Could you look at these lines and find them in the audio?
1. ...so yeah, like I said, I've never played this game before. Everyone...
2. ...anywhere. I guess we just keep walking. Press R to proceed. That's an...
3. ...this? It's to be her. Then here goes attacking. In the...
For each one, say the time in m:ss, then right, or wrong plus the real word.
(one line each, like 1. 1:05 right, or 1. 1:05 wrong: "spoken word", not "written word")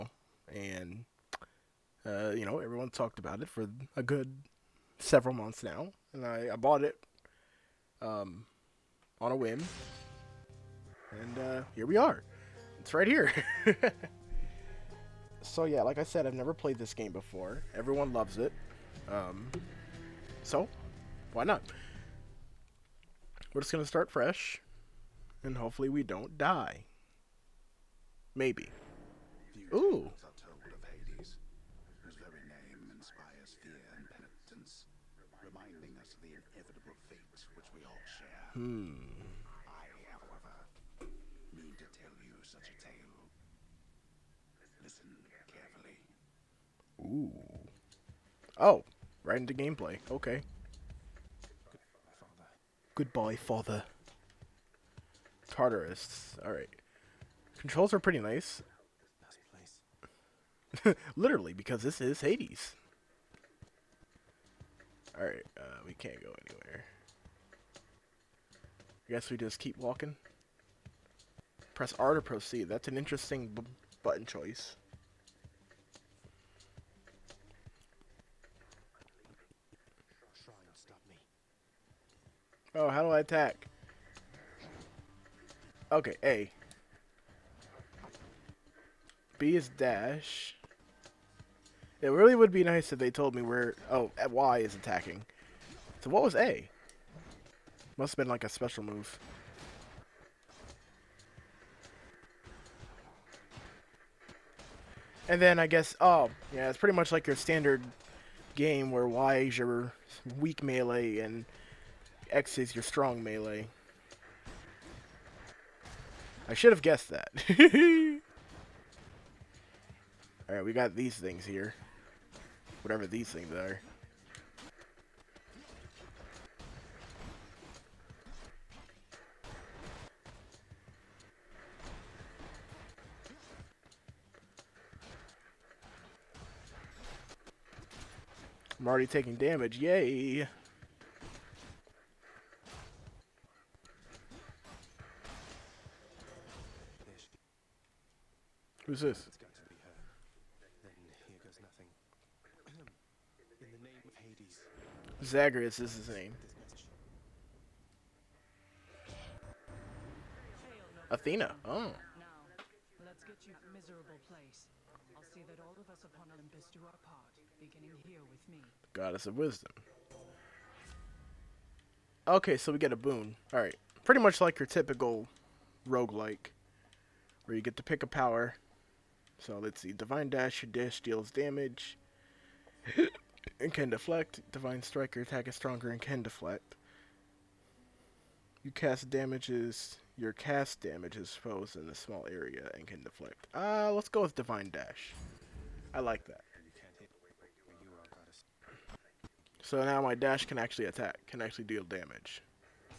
1. 0:15 right
2. 1:06 right
3. 2:29 wrong: "nothing", not "attacking".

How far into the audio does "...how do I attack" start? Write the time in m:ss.
1:22.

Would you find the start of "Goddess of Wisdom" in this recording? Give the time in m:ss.
2:48.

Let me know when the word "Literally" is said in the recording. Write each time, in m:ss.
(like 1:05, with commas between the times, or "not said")
1:01.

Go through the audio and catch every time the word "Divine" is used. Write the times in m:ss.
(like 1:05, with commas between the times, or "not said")
2:59, 3:04, 3:14.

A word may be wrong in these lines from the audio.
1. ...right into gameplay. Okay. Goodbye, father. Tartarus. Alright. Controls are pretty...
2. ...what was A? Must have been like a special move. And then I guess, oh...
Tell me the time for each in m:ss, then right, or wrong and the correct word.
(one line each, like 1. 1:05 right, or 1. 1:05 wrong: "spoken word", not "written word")
1. 0:49 right
2. 1:36 right.